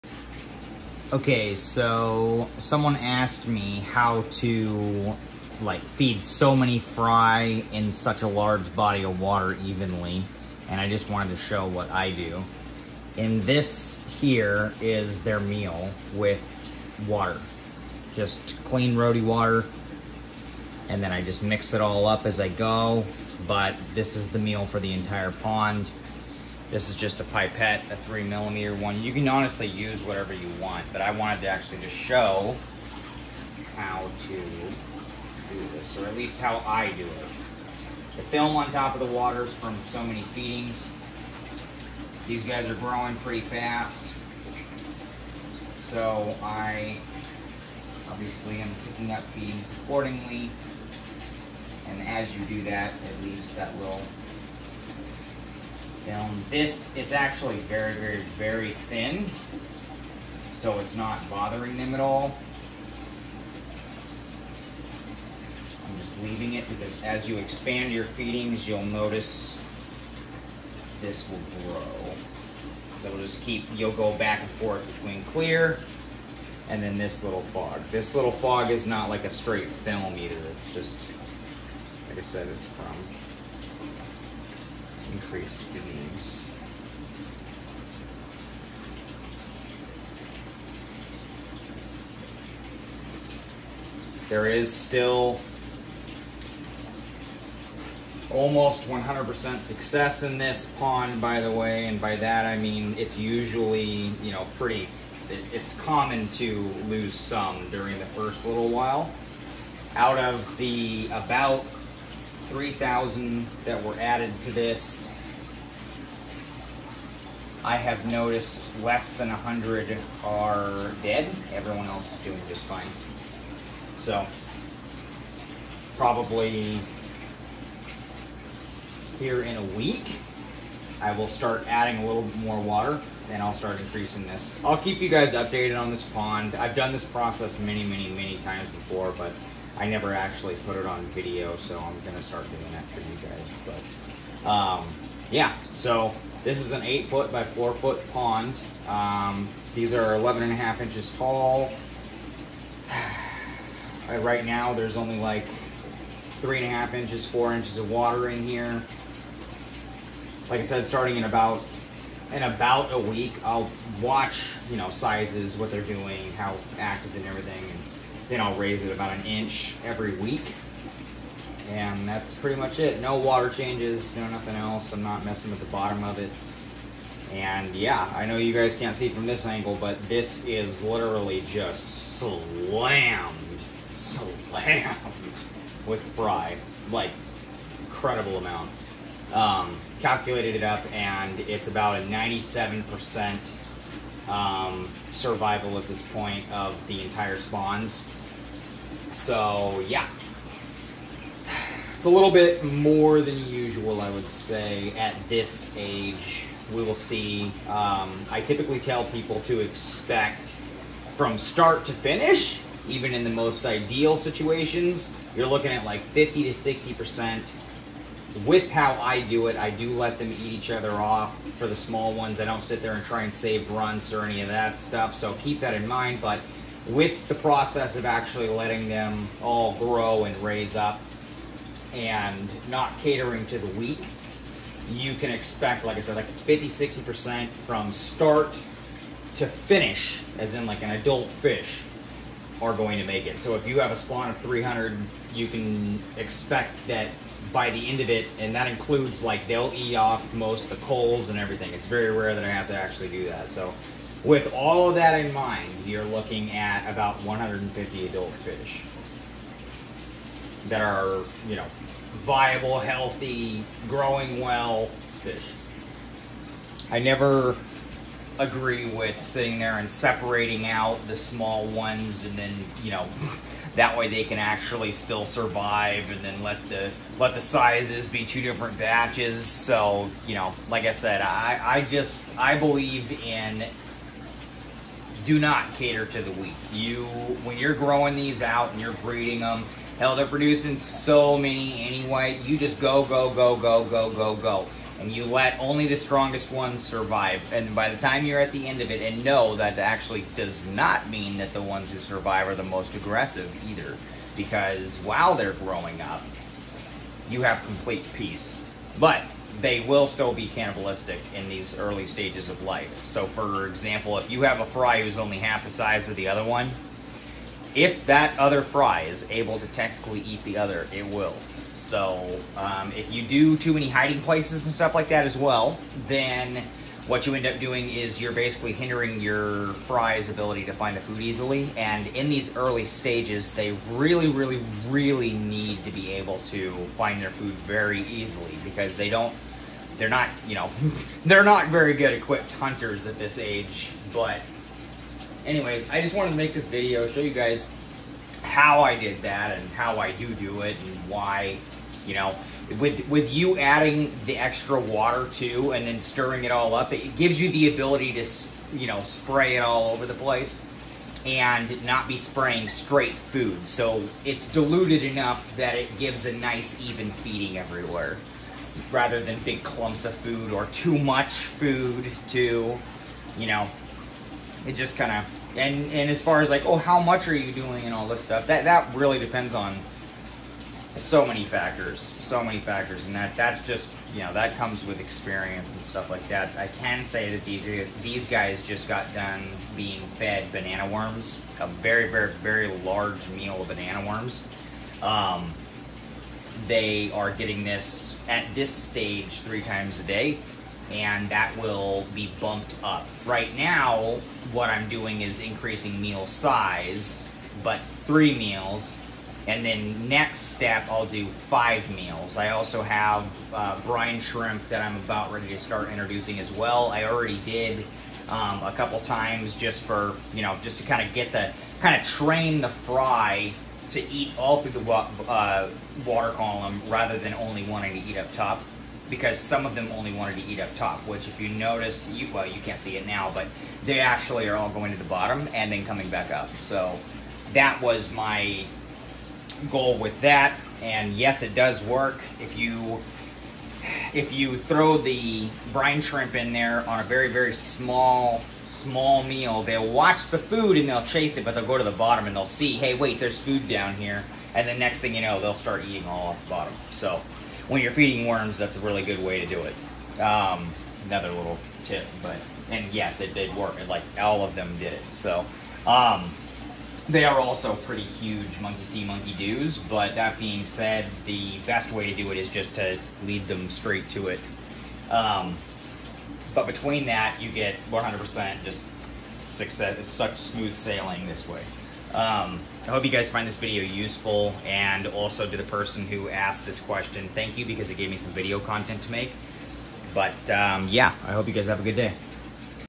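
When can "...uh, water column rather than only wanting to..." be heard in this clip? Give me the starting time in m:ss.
7:05.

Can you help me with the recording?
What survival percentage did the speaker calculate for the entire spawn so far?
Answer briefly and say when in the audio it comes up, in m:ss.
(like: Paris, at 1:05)
97%, at 3:12.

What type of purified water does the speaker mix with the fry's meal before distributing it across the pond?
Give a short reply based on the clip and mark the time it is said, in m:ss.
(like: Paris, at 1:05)
RODI water, at 0:18.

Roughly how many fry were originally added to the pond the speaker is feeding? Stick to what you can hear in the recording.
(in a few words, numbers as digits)
3,000.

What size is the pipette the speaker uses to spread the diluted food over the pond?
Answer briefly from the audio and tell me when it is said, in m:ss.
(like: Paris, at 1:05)
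3 millimeter, at 0:27.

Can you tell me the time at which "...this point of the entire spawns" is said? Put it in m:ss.
3:15.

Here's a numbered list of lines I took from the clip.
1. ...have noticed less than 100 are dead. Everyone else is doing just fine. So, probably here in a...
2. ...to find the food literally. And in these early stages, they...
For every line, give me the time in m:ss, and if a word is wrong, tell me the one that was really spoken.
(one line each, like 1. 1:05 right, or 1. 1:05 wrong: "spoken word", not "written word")
1. 1:57 right
2. 5:30 wrong: "easily", not "literally".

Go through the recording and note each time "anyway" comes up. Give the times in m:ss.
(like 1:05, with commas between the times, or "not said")
4:51, 5:45.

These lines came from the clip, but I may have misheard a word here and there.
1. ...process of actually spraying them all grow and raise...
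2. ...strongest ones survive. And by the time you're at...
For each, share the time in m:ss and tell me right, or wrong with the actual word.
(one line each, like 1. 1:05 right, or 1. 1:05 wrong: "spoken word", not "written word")
1. 3:47 wrong: "letting", not "spraying"
2. 4:55 right.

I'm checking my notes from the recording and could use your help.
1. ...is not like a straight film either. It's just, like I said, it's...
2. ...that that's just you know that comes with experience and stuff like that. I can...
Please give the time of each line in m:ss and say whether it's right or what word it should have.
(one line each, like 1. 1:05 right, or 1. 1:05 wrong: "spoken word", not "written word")
1. 1:18 right
2. 6:23 right.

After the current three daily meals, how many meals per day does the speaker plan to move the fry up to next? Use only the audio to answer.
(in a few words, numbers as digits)
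5.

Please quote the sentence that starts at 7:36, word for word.
So when you're feeding worms, that's a really good way to do it.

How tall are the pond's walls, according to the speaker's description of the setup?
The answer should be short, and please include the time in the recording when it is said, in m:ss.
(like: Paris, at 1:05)
11.5 inches, at 2:30.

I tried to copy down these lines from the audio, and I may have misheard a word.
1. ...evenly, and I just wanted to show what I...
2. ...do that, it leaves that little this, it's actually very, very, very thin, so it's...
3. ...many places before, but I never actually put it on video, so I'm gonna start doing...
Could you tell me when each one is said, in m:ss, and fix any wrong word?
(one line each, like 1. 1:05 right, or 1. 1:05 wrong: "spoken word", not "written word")
1. 0:09 right
2. 0:52 right
3. 2:18 wrong: "times", not "places".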